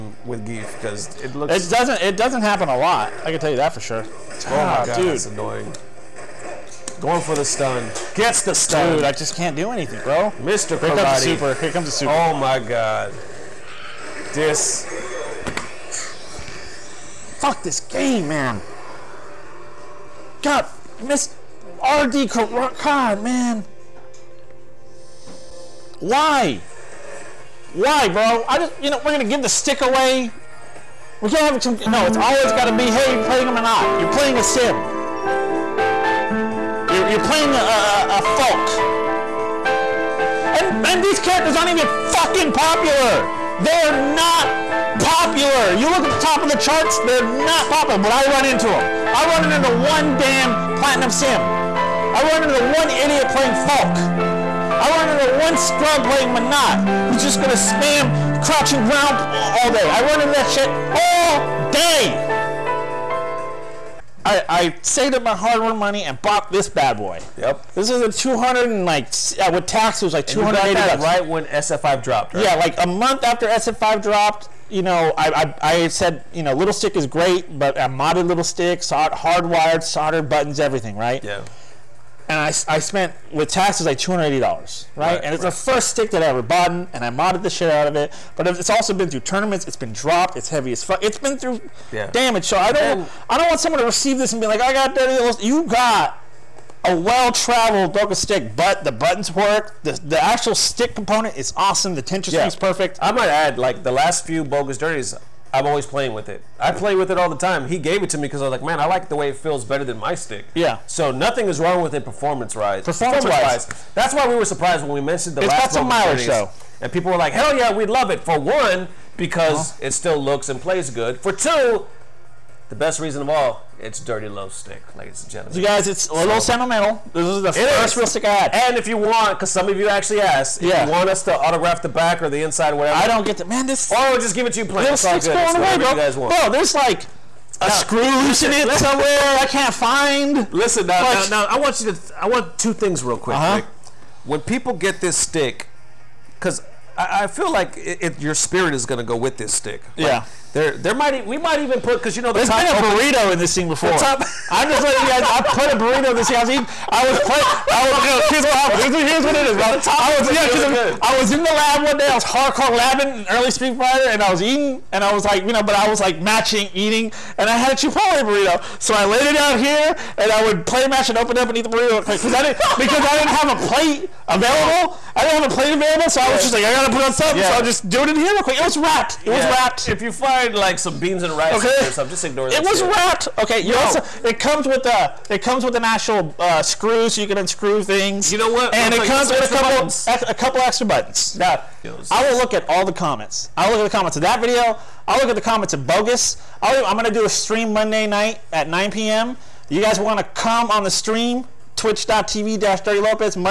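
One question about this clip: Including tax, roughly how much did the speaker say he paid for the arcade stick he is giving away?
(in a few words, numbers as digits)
$280.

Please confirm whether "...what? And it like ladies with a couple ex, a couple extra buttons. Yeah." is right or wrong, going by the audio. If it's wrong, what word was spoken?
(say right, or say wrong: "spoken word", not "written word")
wrong: "comes", not "ladies".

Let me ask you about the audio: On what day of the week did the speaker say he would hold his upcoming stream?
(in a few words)
Monday.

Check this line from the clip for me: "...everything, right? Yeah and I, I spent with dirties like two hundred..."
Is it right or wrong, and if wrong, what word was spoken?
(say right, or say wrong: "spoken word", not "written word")
wrong: "taxes", not "dirties".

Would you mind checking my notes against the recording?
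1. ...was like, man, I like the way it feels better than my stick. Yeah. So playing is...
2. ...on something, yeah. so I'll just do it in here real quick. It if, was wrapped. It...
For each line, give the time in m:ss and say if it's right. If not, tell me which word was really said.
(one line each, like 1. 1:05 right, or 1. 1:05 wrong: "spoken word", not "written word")
1. 1:48 wrong: "nothing", not "playing"
2. 2:57 right.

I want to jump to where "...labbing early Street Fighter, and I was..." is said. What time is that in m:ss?
2:42.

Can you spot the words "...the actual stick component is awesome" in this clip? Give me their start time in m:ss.
1:39.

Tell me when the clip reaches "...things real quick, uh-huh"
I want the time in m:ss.
2:22.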